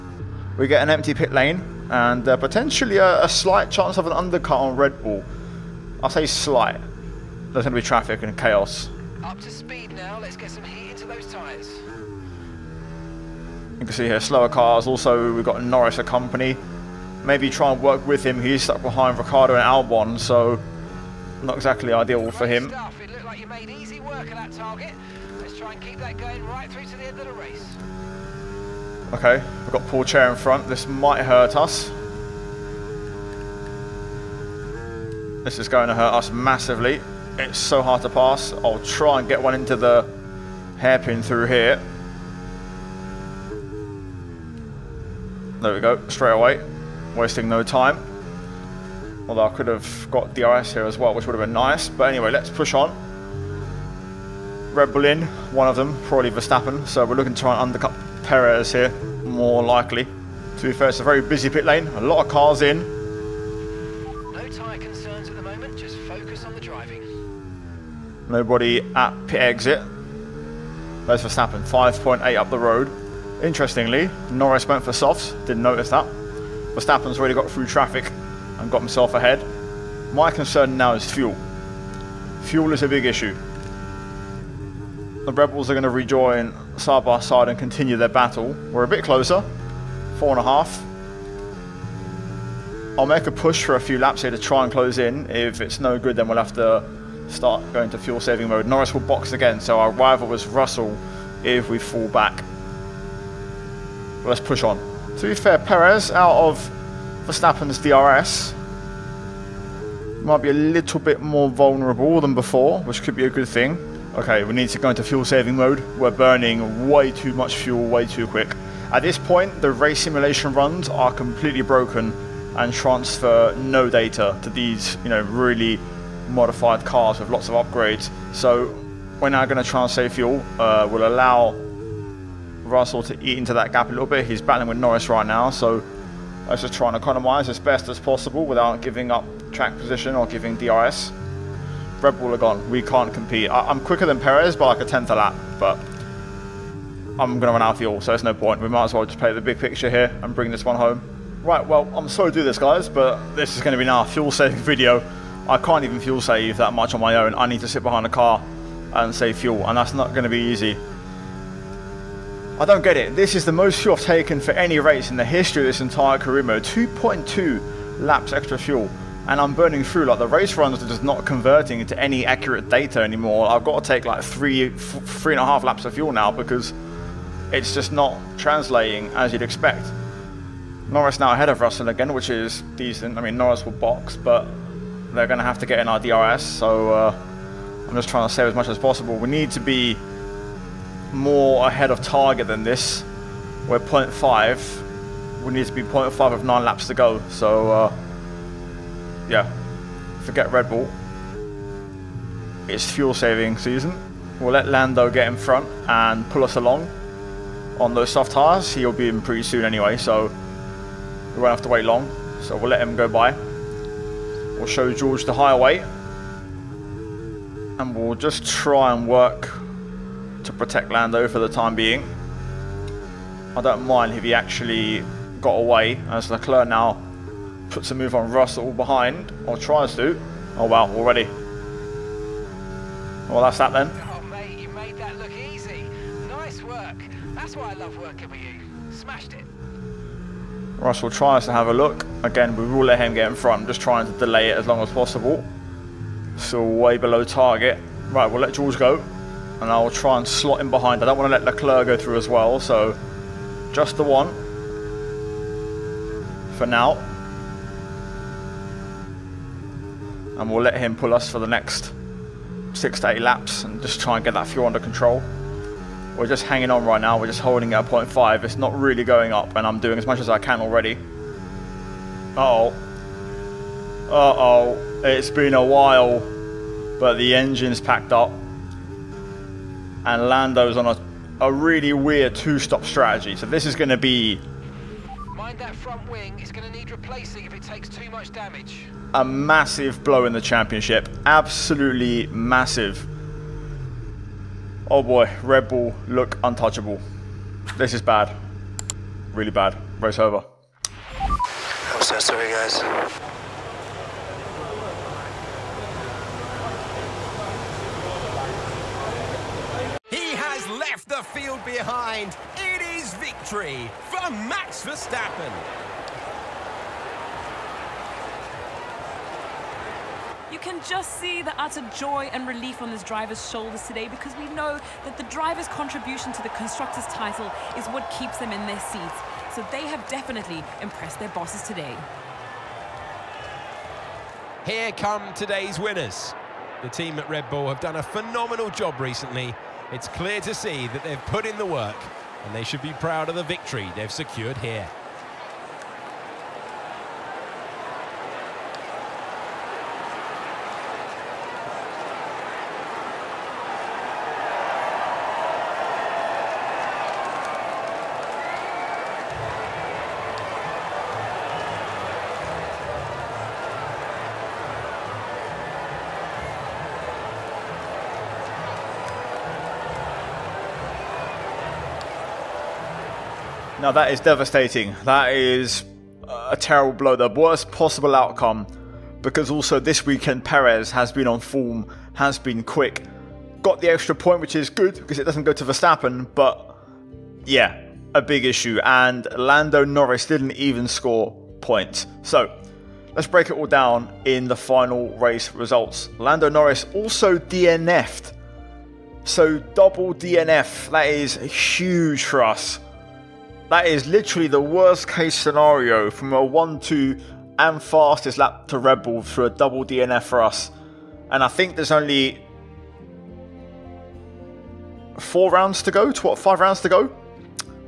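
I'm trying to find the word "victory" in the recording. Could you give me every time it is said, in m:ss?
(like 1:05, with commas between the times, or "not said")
5:13, 5:43.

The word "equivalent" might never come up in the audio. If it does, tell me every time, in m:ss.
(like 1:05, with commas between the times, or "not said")
not said.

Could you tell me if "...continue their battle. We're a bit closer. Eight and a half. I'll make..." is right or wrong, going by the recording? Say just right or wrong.
wrong.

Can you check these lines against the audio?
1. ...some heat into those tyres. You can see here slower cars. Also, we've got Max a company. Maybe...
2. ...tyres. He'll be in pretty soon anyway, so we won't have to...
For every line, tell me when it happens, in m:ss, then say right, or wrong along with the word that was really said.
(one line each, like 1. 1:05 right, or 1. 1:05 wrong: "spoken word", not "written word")
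1. 0:10 wrong: "Norris", not "Max"
2. 3:28 right.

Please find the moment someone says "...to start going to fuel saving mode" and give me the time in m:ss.
1:36.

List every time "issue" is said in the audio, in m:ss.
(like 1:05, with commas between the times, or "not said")
1:23, 6:28.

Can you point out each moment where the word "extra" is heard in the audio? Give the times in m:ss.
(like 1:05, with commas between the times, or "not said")
2:48, 6:23.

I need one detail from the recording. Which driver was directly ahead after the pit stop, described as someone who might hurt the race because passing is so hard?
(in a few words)
Pourchaire.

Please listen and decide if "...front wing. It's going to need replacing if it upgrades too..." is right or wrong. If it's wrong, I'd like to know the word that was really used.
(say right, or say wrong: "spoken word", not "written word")
wrong: "takes", not "upgrades".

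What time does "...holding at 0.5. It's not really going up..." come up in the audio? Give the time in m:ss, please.
4:27.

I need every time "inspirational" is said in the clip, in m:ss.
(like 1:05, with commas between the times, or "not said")
not said.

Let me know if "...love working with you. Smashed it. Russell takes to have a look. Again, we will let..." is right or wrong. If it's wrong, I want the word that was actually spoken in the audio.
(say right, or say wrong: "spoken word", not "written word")
wrong: "tries", not "takes".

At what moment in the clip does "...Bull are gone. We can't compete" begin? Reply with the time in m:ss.
2:22.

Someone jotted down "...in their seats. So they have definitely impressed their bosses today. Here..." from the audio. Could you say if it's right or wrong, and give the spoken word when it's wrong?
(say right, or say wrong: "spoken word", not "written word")
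right.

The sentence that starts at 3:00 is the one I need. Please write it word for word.
Norris now ahead of Russell again, which is decent.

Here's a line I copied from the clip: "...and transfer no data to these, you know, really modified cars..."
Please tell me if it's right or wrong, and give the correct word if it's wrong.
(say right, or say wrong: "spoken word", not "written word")
right.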